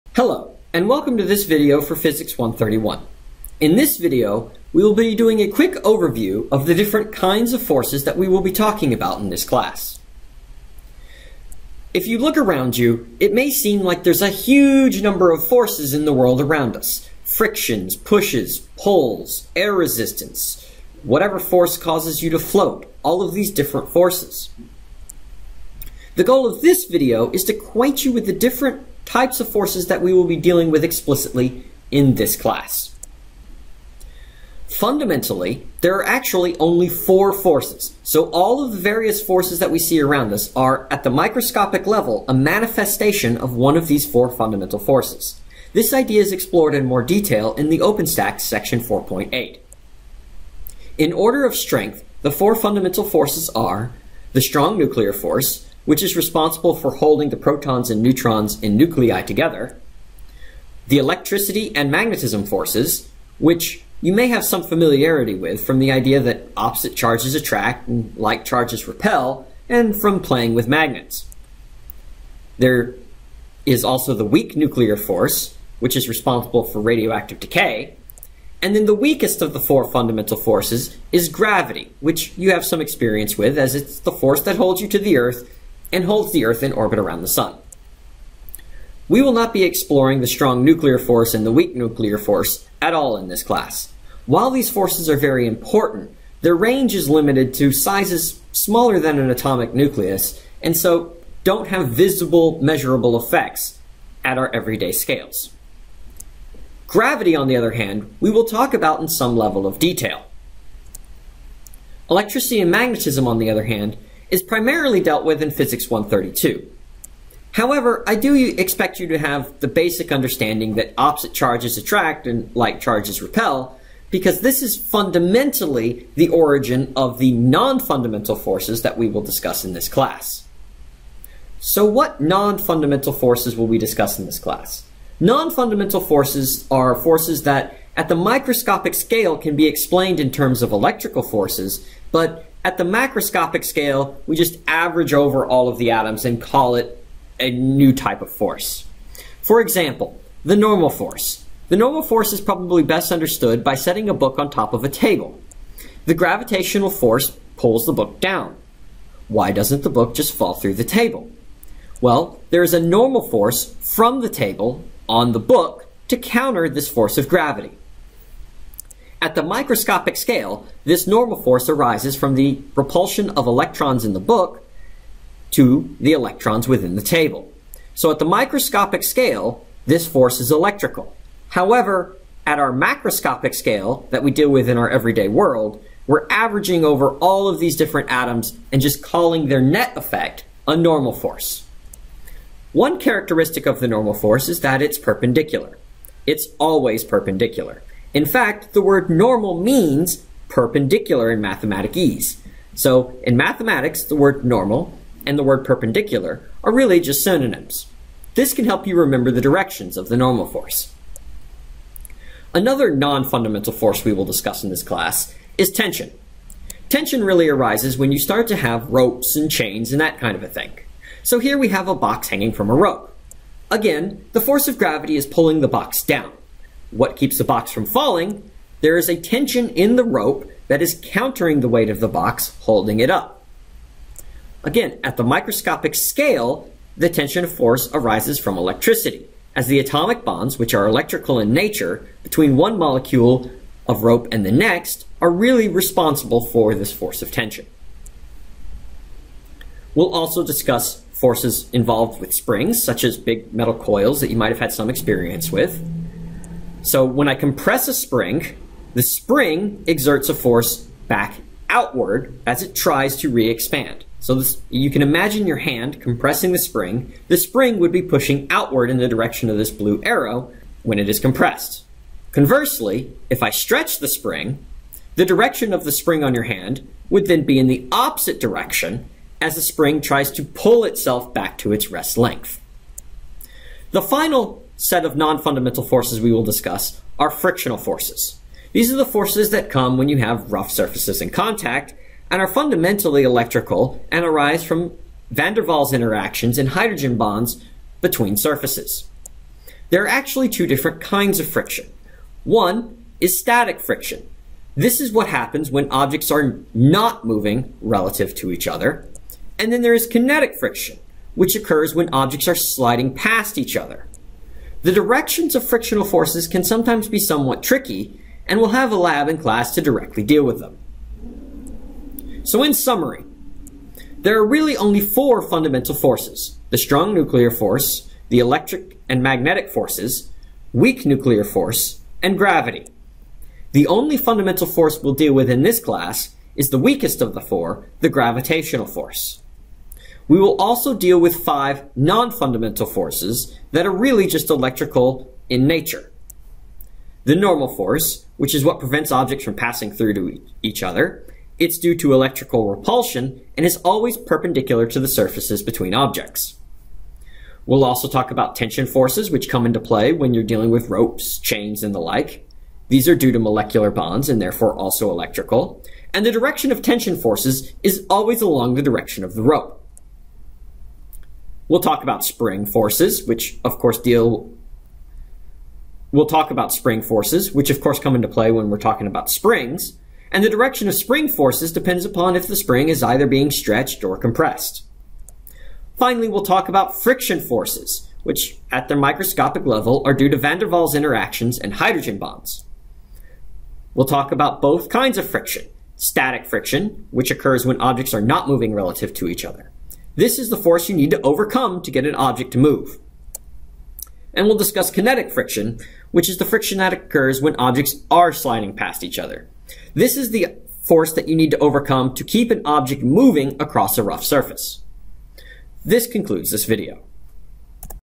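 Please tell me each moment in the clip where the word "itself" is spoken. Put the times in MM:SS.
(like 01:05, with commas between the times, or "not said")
04:40.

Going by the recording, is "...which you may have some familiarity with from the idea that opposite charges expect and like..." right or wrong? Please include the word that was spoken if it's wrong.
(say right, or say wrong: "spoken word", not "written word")
wrong: "attract", not "expect".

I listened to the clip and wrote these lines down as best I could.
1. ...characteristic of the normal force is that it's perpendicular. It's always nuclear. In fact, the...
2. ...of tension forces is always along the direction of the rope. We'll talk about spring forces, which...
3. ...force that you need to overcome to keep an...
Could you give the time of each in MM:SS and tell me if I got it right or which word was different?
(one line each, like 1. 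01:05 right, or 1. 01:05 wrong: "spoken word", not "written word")
1. 03:12 wrong: "perpendicular", not "nuclear"
2. 06:06 right
3. 06:50 right.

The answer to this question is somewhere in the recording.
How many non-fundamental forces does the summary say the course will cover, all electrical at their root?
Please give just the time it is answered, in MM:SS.
05:41.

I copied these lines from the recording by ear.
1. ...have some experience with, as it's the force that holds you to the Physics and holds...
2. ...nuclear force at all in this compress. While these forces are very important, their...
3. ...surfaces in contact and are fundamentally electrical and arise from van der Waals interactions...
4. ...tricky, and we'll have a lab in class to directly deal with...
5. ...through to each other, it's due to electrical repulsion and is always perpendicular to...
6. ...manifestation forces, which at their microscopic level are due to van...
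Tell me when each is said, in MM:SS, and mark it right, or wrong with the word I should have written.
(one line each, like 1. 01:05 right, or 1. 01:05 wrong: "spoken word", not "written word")
1. 01:22 wrong: "Earth", not "Physics"
2. 01:31 wrong: "class", not "compress"
3. 04:50 right
4. 05:17 right
5. 05:49 right
6. 06:27 wrong: "friction", not "manifestation".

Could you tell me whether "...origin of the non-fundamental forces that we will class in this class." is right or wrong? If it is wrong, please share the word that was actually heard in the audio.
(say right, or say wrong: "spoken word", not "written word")
wrong: "discuss", not "class".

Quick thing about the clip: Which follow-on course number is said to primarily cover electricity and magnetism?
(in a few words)
Physics 132.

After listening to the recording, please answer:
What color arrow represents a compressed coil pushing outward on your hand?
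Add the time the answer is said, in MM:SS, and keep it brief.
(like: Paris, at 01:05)
Blue, at 04:29.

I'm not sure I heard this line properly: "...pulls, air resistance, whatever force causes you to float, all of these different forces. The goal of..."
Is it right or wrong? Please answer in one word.
right.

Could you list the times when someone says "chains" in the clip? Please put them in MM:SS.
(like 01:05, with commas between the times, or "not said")
03:39, 06:01.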